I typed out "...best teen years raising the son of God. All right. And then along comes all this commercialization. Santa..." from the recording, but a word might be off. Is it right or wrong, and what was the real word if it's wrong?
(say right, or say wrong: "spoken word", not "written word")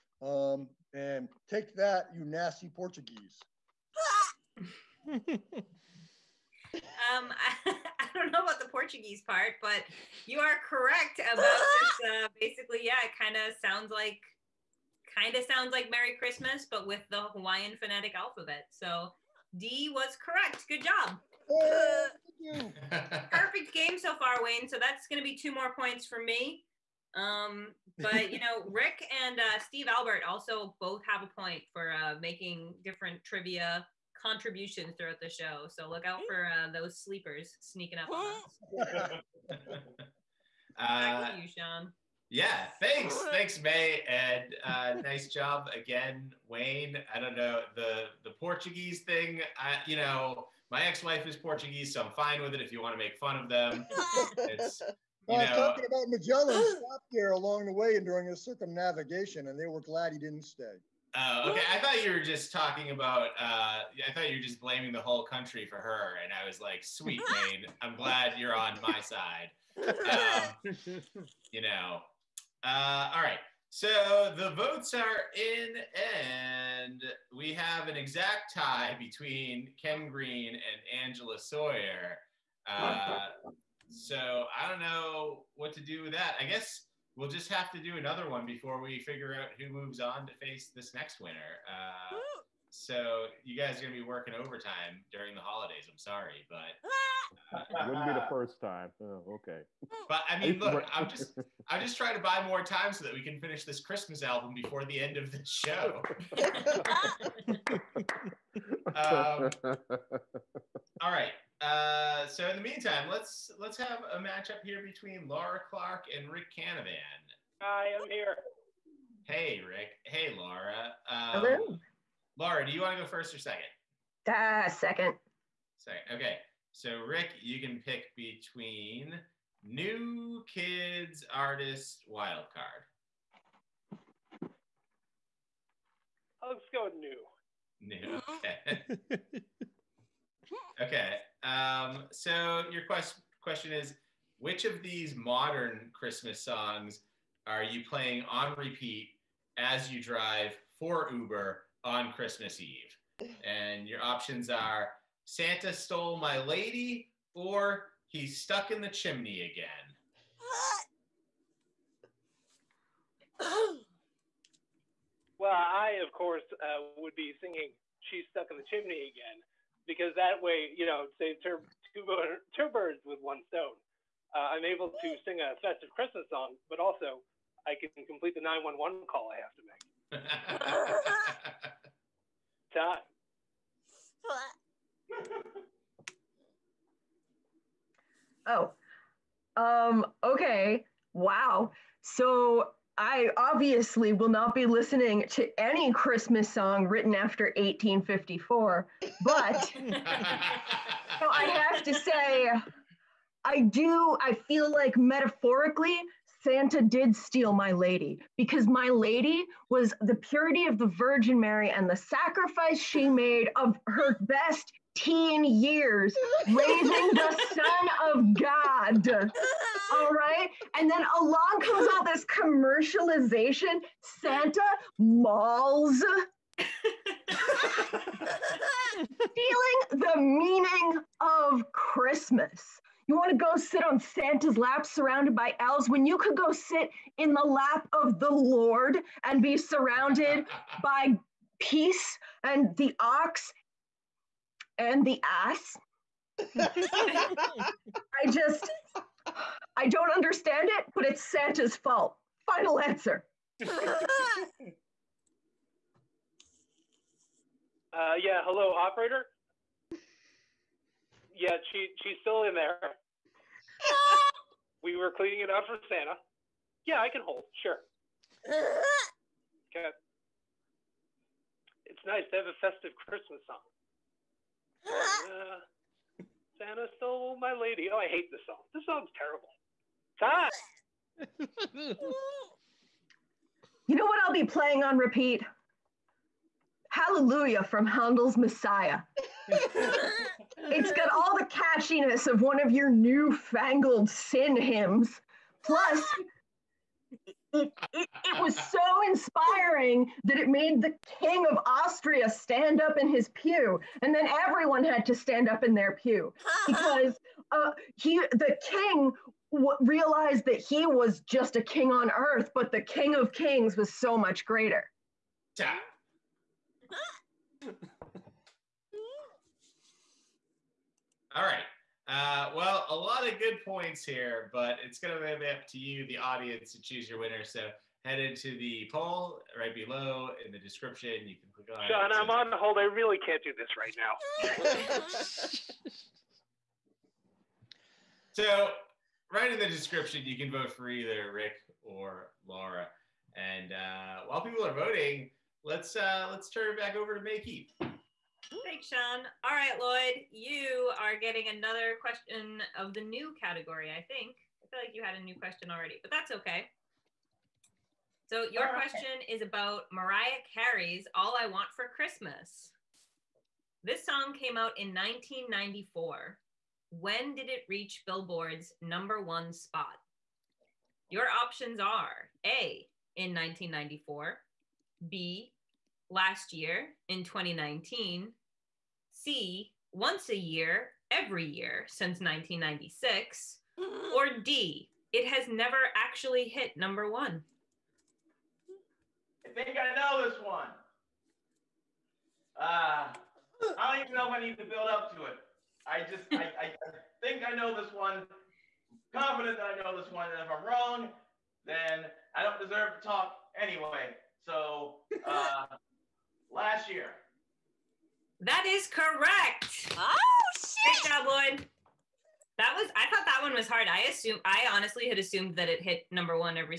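right.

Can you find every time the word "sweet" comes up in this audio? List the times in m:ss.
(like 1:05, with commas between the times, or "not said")
1:06.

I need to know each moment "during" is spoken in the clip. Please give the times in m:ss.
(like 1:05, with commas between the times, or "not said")
0:58, 1:35.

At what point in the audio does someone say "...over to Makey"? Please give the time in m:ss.
5:46.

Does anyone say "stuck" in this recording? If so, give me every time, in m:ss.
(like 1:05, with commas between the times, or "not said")
2:38, 2:48.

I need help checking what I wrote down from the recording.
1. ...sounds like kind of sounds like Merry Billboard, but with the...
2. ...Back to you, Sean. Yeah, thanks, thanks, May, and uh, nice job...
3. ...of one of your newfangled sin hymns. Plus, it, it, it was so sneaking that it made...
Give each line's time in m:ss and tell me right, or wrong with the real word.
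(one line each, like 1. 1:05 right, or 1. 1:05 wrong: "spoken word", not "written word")
1. 0:13 wrong: "Christmas", not "Billboard"
2. 0:41 right
3. 4:52 wrong: "inspiring", not "sneaking".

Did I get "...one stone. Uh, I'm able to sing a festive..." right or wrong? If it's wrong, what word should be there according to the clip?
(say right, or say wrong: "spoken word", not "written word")
right.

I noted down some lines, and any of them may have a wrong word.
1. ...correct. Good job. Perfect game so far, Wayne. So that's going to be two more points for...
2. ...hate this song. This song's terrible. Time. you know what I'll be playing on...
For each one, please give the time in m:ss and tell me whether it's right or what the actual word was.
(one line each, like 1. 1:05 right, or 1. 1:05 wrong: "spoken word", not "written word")
1. 0:20 right
2. 4:38 right.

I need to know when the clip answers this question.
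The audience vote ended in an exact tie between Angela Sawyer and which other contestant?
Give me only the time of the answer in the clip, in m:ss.
1:19.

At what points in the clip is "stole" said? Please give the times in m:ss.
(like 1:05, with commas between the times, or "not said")
2:35, 4:36.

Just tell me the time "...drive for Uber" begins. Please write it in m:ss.
2:30.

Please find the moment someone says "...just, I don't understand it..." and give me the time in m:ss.
4:08.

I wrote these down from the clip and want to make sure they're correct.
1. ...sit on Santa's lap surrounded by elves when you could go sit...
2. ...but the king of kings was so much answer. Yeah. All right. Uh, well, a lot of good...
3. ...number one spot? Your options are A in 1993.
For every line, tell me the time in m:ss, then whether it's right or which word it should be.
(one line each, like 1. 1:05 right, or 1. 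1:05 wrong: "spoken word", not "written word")
1. 3:53 right
2. 5:12 wrong: "greater", not "answer"
3. 6:08 wrong: "1994", not "1993".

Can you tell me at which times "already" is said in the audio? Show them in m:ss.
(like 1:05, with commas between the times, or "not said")
5:55.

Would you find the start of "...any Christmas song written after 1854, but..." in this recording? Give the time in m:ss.
3:15.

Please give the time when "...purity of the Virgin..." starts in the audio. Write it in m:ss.
3:30.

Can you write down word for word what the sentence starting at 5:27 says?
So head into the poll right below in the description.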